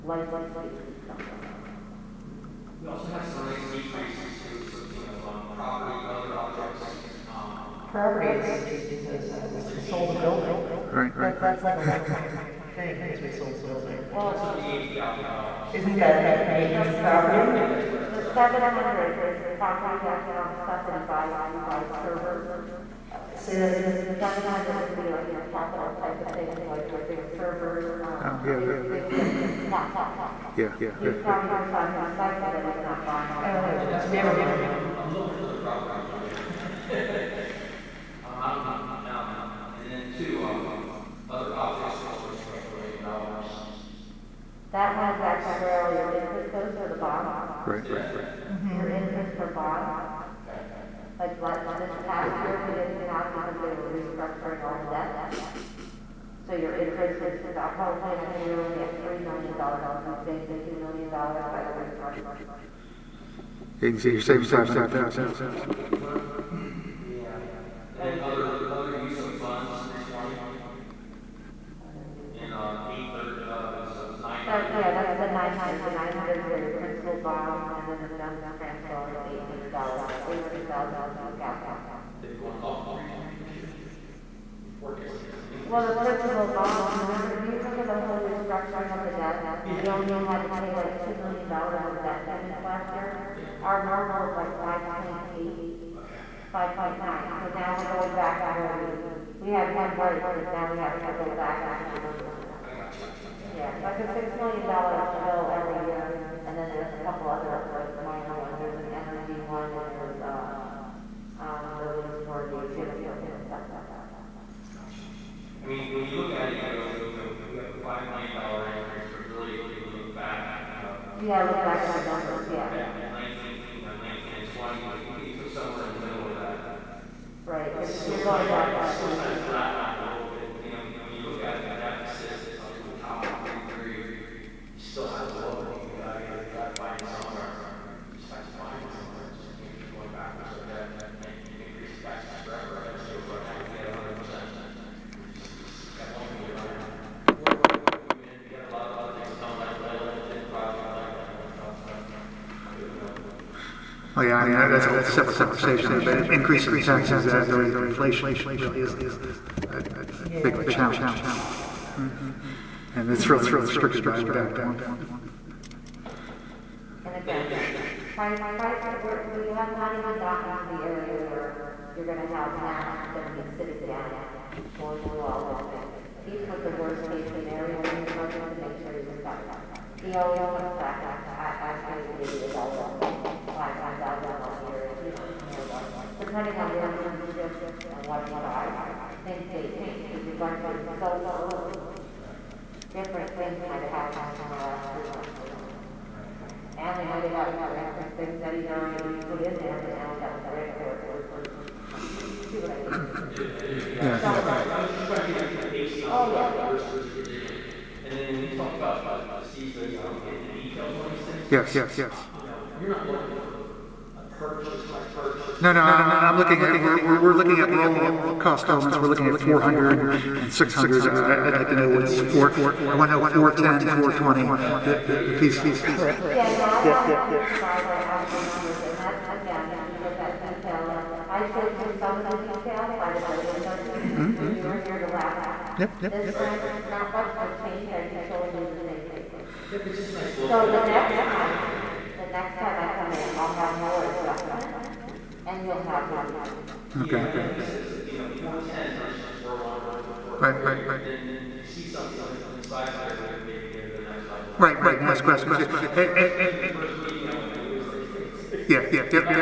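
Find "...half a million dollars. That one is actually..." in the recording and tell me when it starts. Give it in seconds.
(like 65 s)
42 s.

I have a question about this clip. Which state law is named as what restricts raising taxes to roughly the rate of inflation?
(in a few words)
Act 1.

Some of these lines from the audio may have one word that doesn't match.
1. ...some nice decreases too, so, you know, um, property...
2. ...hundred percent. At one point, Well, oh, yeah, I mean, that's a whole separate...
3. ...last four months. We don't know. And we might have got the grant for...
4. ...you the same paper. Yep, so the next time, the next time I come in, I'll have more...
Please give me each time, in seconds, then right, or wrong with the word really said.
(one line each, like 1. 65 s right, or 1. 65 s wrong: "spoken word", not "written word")
1. 3 s right
2. 143 s right
3. 194 s wrong: "three", not "four"
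4. 238 s right.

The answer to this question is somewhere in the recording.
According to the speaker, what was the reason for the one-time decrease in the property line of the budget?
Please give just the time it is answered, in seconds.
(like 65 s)
9 s.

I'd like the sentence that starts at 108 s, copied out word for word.
There's an energy one, and there's, uh, um, the lease for the gym equipment and stuff like that.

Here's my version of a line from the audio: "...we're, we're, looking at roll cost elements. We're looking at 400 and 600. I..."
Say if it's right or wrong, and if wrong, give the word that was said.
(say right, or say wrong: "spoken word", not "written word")
right.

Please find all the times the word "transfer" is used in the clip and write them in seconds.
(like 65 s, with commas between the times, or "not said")
78 s.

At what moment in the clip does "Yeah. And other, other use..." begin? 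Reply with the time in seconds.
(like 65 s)
67 s.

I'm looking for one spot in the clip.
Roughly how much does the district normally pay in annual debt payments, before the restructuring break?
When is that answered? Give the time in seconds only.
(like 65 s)
94 s.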